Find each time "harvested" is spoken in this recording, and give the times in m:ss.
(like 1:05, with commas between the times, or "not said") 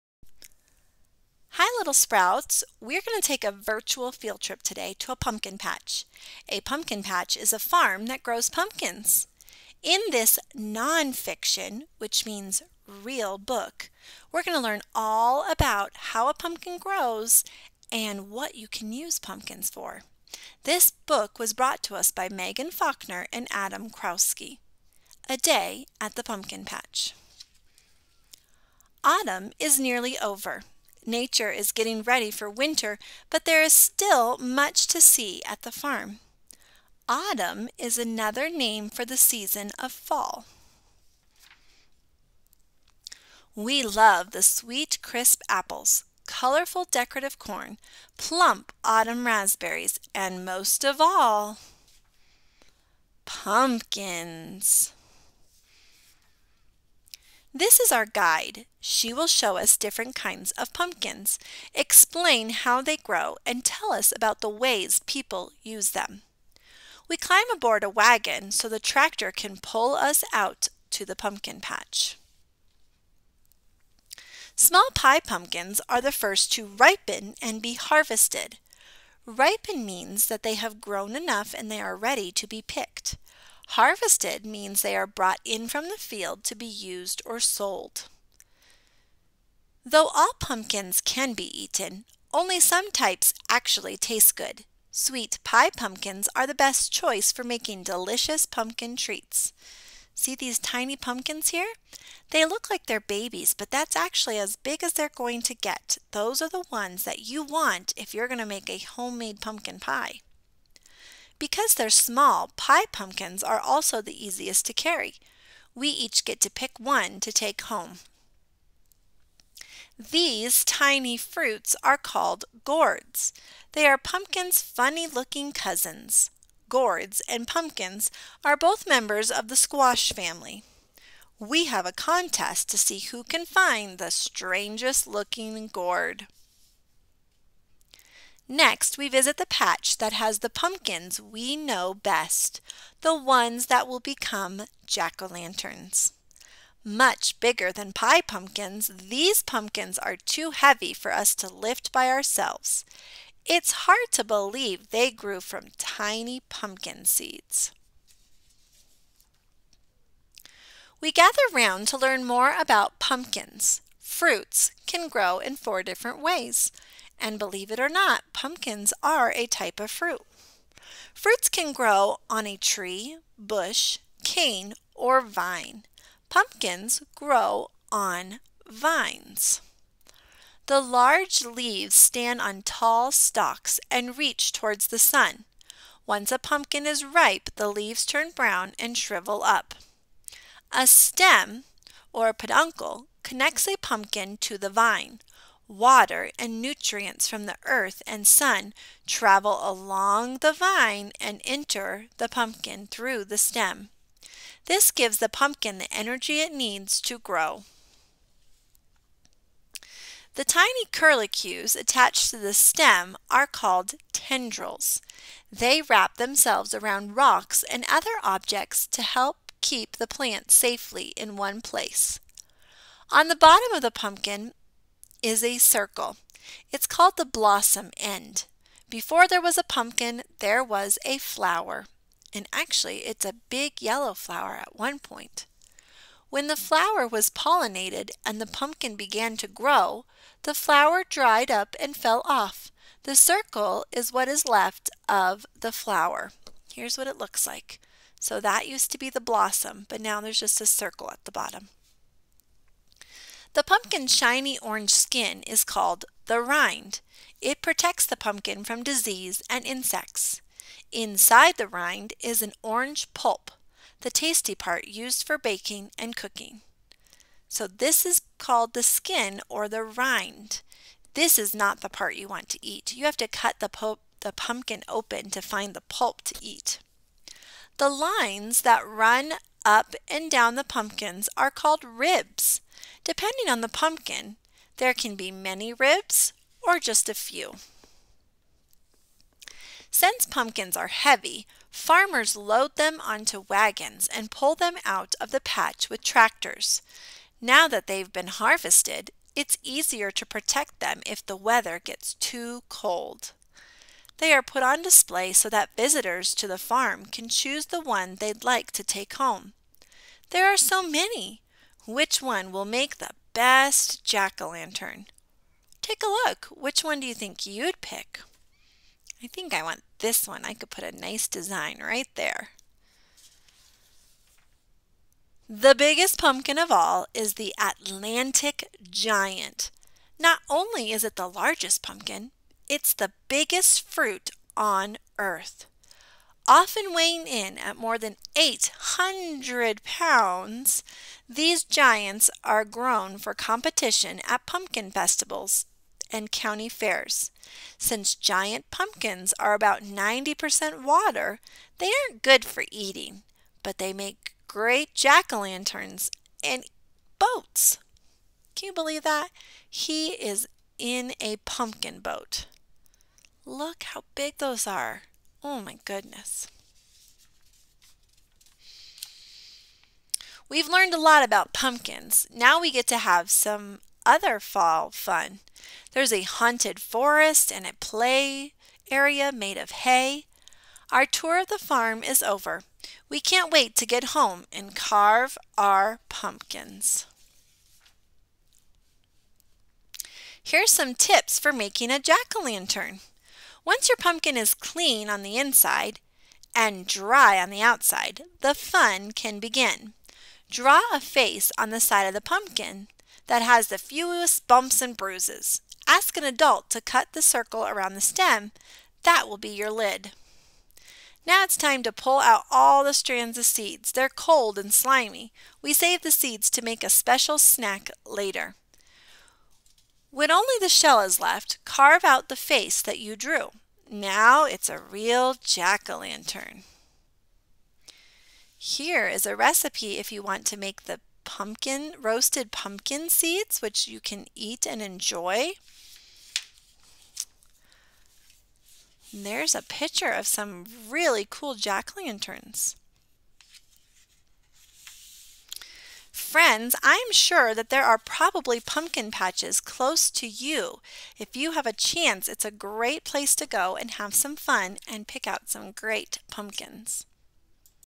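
1:17, 1:23, 4:58.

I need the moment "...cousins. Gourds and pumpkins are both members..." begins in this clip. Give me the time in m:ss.
2:05.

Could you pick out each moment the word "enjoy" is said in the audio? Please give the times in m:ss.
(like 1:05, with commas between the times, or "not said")
7:14.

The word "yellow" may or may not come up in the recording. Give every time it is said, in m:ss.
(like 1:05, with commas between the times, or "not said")
3:53.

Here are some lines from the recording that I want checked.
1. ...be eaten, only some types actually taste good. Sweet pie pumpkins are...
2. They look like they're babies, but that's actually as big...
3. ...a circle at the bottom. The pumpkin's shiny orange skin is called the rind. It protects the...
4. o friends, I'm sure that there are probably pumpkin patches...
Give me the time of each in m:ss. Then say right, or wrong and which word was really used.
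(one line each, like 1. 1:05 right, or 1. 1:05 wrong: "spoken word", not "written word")
1. 1:31 right
2. 1:42 right
3. 4:10 right
4. 7:22 right.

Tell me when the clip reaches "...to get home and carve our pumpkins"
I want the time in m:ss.
6:23.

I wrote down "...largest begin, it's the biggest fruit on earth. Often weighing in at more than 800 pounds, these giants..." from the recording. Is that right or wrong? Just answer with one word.
wrong.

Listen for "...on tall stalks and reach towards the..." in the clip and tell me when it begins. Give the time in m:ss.
3:02.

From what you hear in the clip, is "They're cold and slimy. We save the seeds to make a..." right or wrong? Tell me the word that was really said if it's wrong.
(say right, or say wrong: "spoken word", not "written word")
right.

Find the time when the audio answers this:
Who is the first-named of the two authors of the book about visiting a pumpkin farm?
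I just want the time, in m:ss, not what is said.
0:22.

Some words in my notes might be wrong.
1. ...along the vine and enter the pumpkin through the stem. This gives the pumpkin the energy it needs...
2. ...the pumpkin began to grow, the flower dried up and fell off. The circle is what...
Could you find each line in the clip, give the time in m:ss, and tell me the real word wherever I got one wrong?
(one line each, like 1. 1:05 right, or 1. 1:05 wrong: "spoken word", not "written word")
1. 3:19 right
2. 3:58 right.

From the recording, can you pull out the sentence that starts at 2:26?
Much bigger than pie pumpkins, these pumpkins are too heavy for us to lift by ourselves.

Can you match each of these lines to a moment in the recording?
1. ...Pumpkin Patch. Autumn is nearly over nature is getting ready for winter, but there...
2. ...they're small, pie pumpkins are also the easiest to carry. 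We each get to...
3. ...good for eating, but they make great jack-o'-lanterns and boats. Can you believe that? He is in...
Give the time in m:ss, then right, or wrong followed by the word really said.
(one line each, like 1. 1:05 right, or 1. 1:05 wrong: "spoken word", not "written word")
1. 0:26 right
2. 1:51 right
3. 5:52 right.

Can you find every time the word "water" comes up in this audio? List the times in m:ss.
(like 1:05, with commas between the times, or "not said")
3:15, 5:50.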